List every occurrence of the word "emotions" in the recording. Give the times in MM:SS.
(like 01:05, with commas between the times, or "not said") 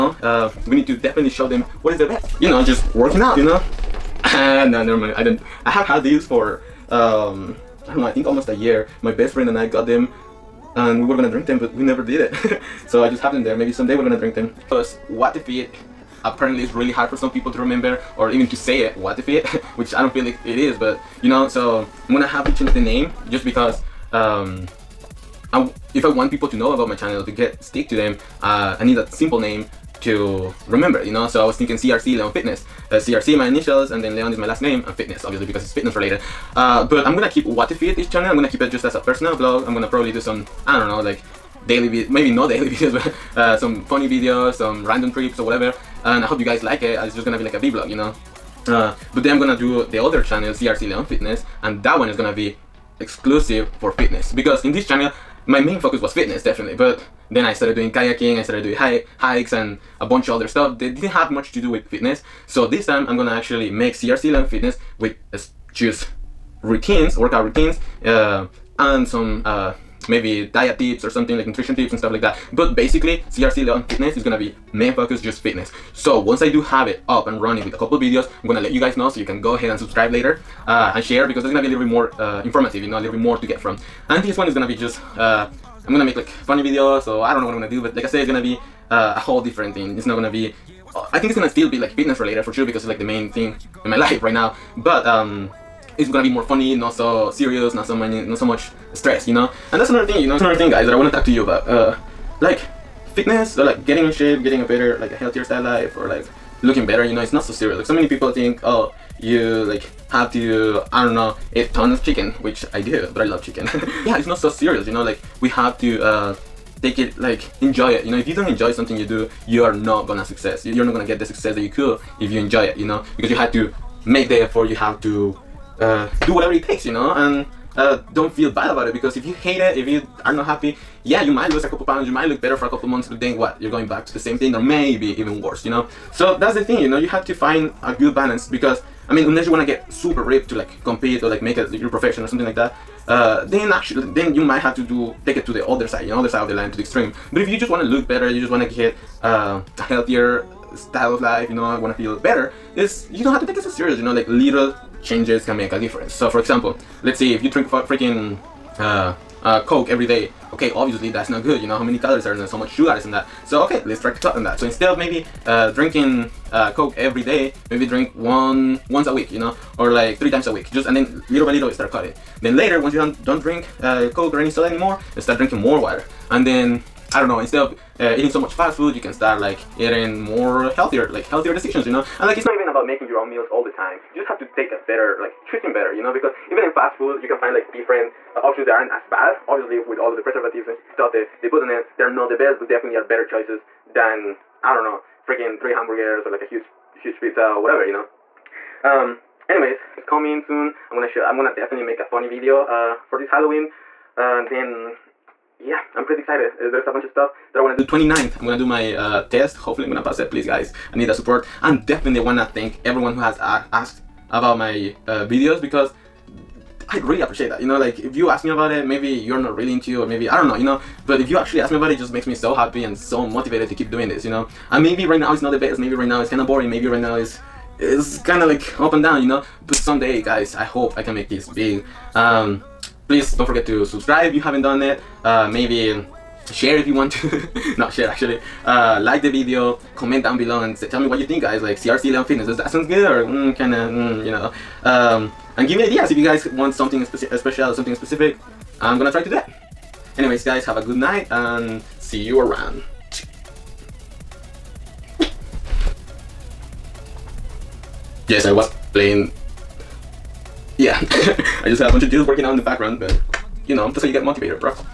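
not said.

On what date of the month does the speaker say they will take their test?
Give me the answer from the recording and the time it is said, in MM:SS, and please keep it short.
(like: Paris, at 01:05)
29th, at 03:27.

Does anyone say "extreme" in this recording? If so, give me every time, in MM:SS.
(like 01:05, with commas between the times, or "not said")
02:26.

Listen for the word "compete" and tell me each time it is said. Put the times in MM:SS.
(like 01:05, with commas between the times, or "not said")
02:20.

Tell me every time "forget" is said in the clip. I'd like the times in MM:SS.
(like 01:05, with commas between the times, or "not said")
03:53.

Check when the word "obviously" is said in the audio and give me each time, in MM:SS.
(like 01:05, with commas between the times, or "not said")
00:35, 02:40, 03:09.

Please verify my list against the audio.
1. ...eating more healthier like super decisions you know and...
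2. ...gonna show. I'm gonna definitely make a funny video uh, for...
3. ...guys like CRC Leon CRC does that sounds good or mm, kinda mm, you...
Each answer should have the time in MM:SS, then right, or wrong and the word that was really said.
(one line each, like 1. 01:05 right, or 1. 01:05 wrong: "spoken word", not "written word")
1. 02:59 wrong: "healthier", not "super"
2. 03:20 right
3. 04:01 wrong: "Fitness", not "CRC".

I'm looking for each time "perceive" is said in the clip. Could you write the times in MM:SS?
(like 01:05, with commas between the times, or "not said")
not said.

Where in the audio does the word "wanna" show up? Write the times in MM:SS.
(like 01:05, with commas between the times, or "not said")
03:27, 03:32.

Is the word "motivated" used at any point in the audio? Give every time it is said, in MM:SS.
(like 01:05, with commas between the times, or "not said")
03:43, 04:24.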